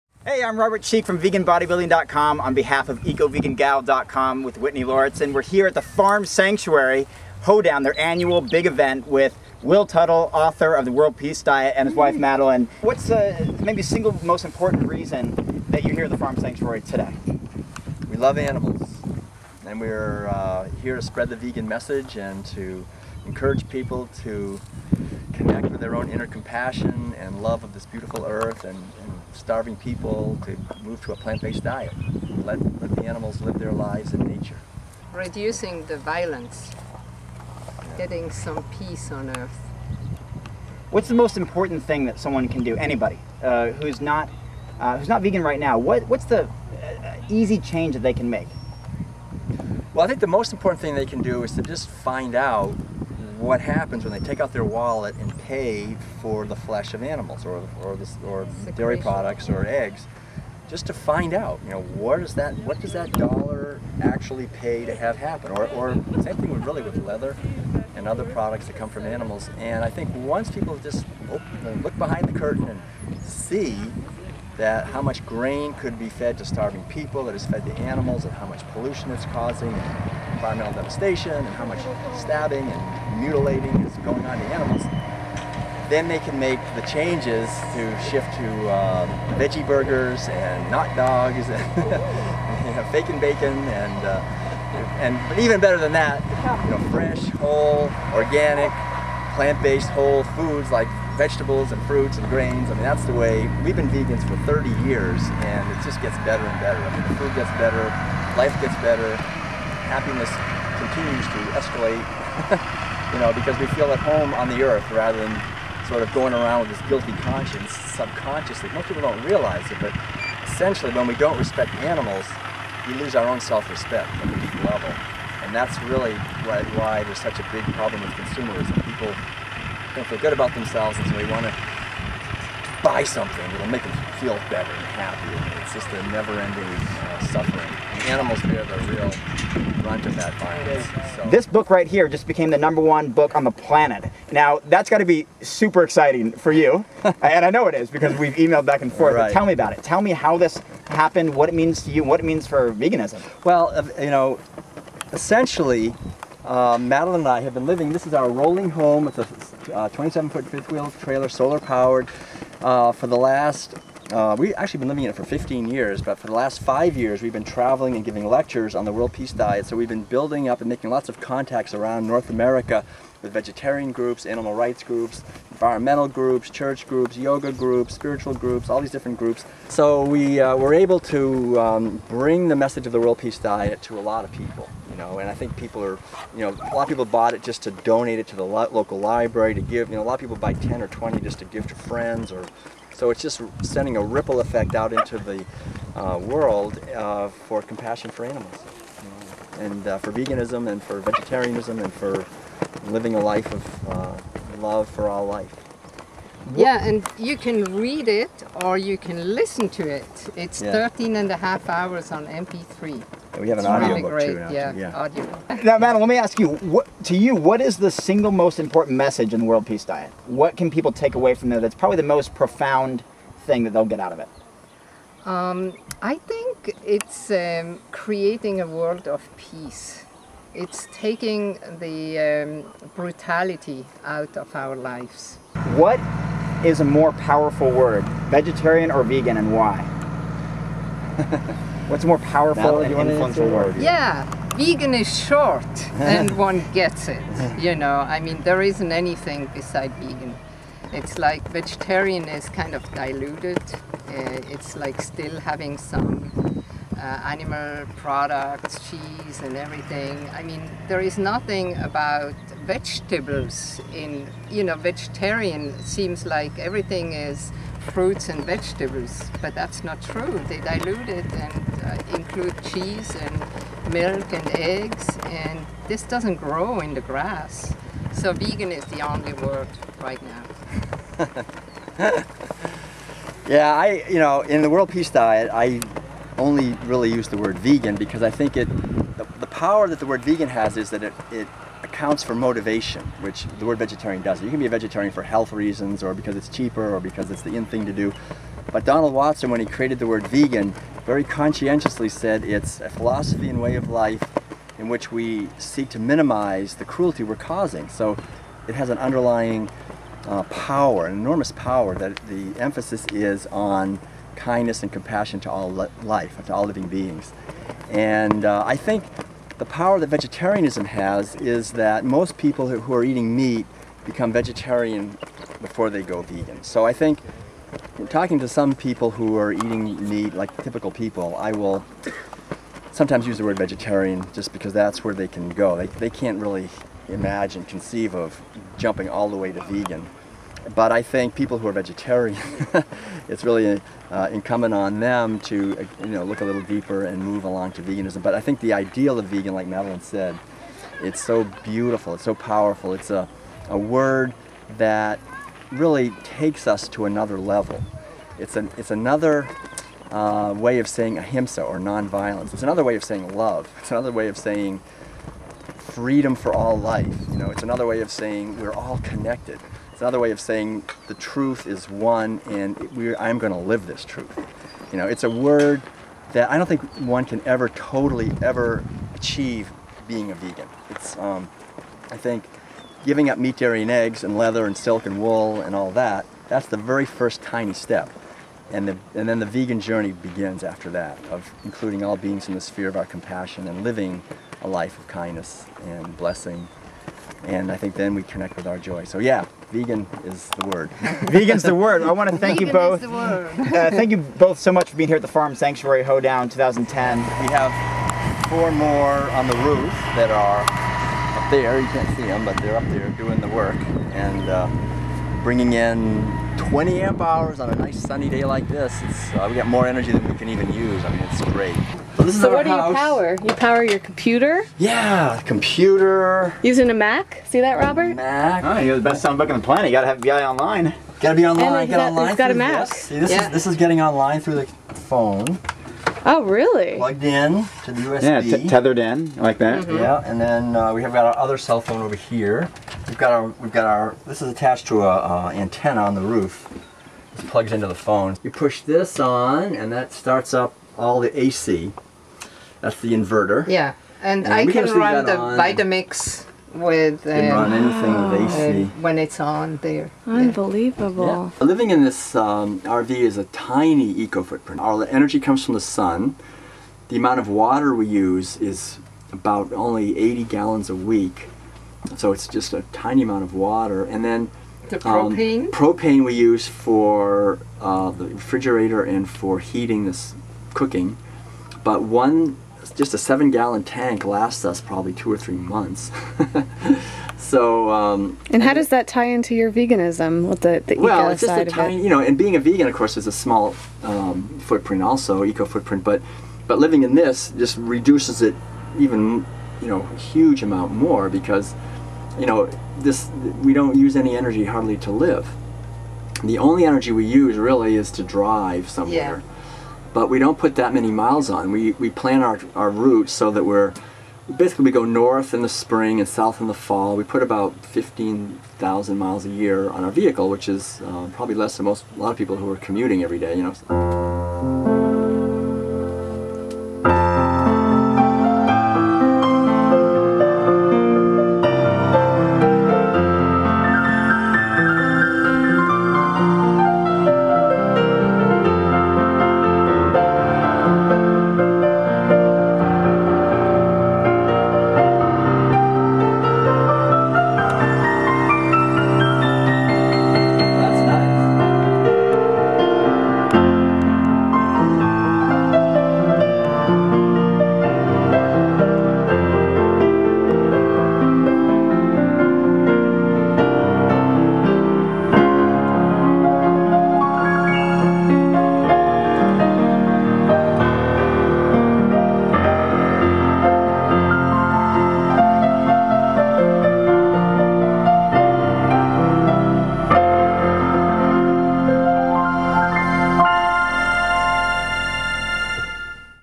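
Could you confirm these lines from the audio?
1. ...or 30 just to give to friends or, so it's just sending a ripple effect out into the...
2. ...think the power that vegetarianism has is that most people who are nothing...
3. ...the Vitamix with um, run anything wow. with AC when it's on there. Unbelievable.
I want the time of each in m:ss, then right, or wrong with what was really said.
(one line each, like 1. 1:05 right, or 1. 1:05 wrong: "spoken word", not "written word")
1. 3:10 wrong: "20", not "30"
2. 5:18 wrong: "eating", not "nothing"
3. 7:35 right.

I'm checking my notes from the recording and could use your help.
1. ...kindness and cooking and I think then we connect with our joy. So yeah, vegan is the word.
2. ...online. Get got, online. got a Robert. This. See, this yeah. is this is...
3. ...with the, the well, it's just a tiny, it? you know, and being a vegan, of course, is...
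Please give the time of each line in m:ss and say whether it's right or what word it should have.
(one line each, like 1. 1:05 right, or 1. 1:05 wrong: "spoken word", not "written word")
1. 6:35 wrong: "blessing", not "cooking"
2. 7:11 wrong: "Mac", not "Robert"
3. 8:10 right.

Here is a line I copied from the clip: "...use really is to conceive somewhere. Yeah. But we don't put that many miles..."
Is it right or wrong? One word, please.
wrong.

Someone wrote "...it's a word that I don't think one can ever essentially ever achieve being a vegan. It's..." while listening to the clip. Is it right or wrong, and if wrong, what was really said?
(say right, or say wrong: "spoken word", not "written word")
wrong: "totally", not "essentially".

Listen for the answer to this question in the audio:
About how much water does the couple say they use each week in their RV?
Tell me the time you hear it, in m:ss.
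7:50.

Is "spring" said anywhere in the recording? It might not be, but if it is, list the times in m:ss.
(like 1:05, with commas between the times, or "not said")
8:35.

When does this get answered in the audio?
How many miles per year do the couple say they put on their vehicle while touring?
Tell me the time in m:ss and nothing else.
8:37.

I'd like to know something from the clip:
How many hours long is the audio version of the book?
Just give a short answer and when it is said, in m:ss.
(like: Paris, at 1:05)
13 and a half hours, at 3:30.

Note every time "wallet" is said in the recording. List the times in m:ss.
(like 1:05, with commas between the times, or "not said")
0:54.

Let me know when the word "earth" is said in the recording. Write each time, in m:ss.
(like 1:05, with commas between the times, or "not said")
0:28, 0:39, 1:54.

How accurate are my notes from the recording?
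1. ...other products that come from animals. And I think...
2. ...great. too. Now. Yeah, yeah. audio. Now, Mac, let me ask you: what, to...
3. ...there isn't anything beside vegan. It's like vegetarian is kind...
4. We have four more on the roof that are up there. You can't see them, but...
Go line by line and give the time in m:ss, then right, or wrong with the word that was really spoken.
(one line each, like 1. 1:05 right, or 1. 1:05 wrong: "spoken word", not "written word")
1. 1:08 right
2. 3:34 wrong: "Madeleine", not "Mac"
3. 4:08 right
4. 6:47 right.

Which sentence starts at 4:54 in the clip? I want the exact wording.
You can be a vegetarian for health reasons or because it's cheaper or because it's the in thing to do.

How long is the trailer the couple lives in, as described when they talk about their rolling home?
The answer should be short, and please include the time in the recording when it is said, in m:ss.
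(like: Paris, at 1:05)
27 feet, at 2:39.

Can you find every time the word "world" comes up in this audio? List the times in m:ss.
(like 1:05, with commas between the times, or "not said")
0:10, 2:48, 3:02, 3:16, 3:39, 3:48, 4:44.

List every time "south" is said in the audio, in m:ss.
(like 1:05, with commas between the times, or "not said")
8:36.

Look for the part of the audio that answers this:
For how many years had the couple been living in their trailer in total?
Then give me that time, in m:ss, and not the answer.
2:45.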